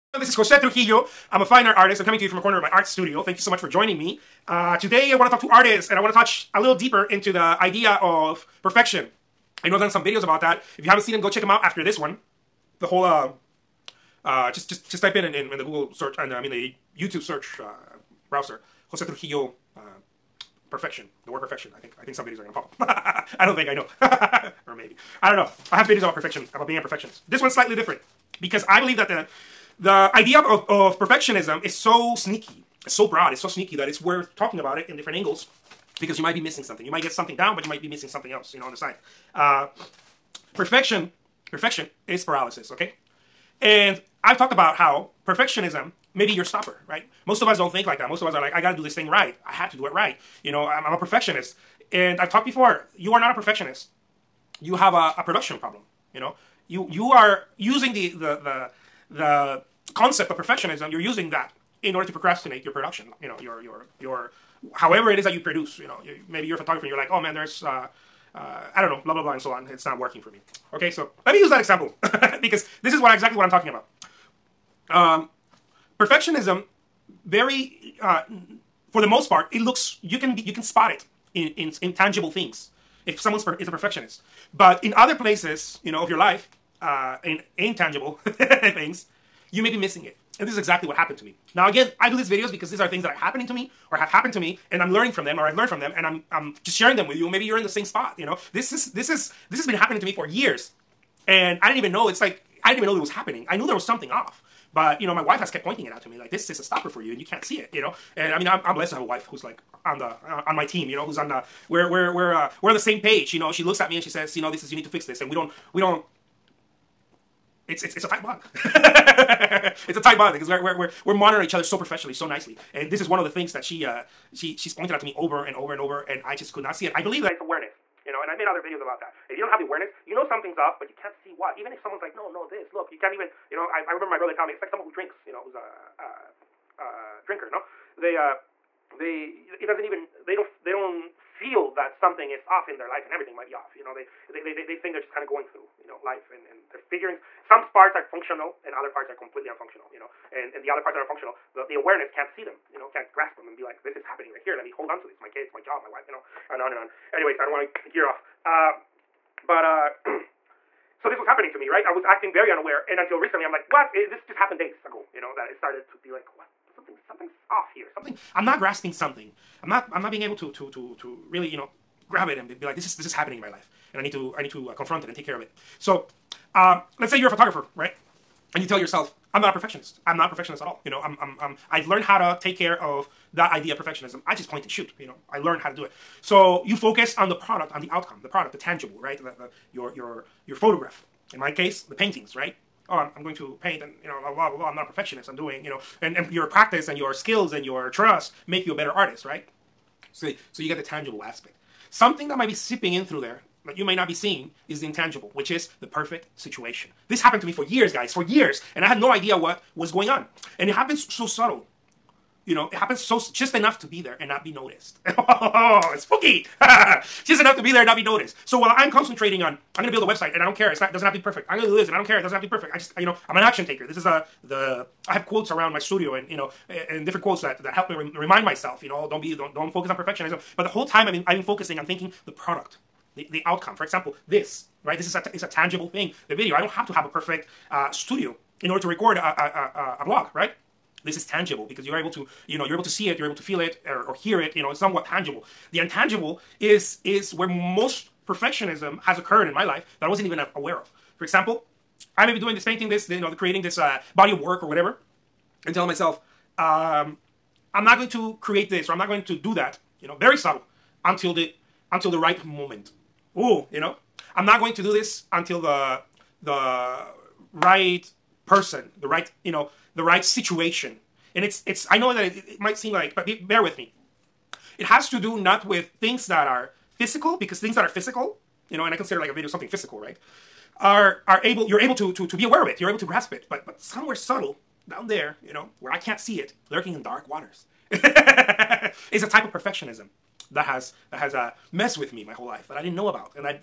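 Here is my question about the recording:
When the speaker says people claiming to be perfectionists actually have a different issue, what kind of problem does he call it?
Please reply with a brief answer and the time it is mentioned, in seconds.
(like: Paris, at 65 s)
A production problem, at 55 s.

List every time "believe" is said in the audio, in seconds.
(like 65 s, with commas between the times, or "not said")
28 s, 127 s.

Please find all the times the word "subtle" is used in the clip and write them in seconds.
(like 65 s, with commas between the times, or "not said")
211 s, 260 s, 284 s.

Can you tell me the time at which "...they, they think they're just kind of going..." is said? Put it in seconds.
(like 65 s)
144 s.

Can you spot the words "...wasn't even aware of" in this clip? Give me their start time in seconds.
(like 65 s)
250 s.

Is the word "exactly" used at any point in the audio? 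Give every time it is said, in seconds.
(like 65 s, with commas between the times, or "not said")
73 s, 90 s.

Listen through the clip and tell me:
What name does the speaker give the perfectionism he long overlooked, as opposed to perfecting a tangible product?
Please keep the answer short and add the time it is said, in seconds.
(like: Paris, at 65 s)
The perfect situation, at 205 s.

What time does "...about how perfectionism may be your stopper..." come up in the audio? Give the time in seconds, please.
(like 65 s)
44 s.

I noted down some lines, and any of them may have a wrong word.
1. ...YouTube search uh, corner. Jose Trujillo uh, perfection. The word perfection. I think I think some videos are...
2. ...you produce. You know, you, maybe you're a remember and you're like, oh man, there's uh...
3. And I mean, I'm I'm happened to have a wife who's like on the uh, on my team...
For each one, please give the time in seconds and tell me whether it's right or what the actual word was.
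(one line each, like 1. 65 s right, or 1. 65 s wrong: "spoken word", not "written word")
1. 16 s wrong: "browser", not "corner"
2. 65 s wrong: "photographer", not "remember"
3. 108 s wrong: "blessed", not "happened".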